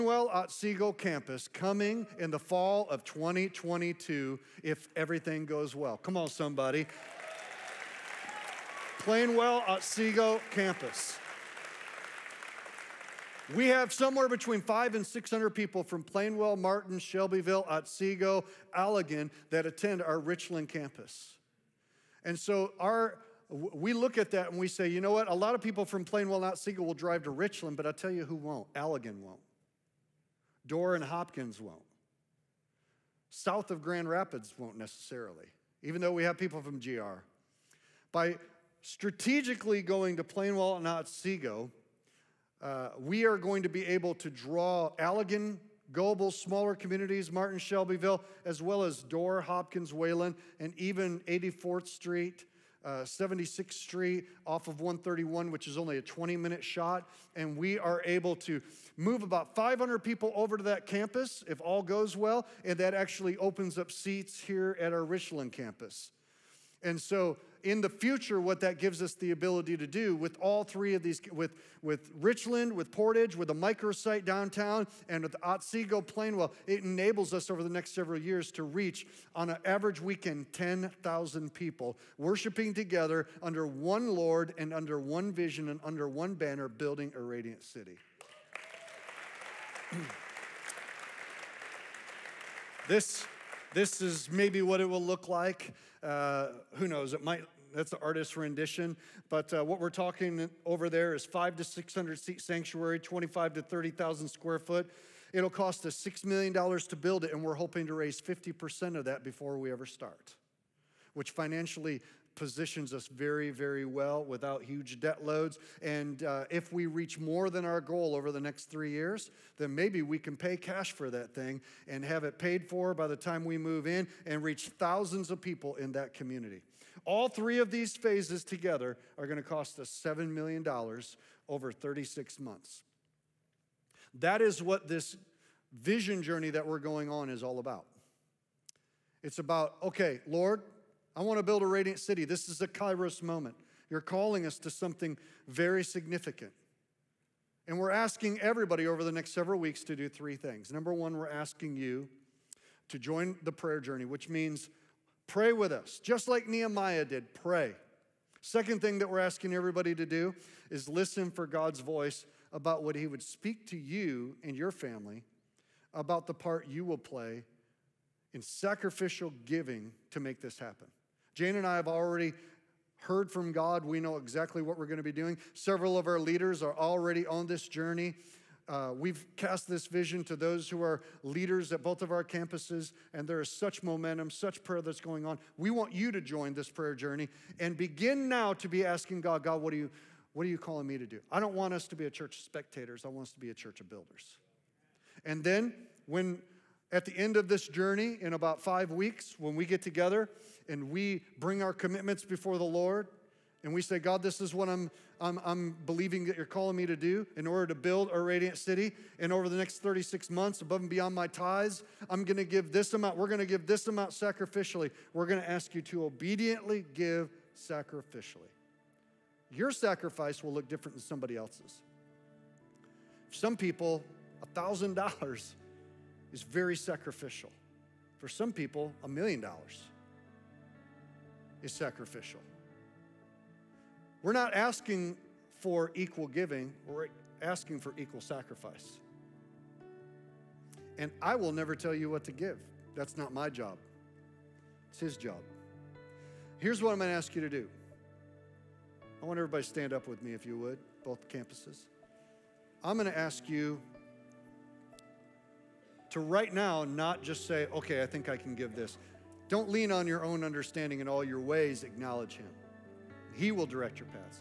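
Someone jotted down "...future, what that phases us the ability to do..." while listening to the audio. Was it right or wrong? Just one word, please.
wrong.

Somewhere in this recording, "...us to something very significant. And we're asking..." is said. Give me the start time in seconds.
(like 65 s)
144 s.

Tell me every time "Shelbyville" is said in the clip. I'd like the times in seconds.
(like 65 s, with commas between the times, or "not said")
16 s, 47 s.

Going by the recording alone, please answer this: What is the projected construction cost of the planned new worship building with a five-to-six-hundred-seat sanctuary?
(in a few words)
$6 million.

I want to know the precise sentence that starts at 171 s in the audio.
Jane and I have already heard from God.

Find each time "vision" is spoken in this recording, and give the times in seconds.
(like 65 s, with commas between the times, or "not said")
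85 s, 135 s, 179 s.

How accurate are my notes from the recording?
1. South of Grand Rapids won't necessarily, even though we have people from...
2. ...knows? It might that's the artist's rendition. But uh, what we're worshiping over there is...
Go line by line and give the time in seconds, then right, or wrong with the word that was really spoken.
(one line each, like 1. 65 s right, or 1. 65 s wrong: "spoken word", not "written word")
1. 33 s right
2. 96 s wrong: "talking", not "worshiping".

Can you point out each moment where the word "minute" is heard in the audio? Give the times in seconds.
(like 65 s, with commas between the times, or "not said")
56 s.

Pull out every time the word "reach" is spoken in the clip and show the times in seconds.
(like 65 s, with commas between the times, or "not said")
78 s, 116 s, 124 s.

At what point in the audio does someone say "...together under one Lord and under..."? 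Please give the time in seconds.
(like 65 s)
82 s.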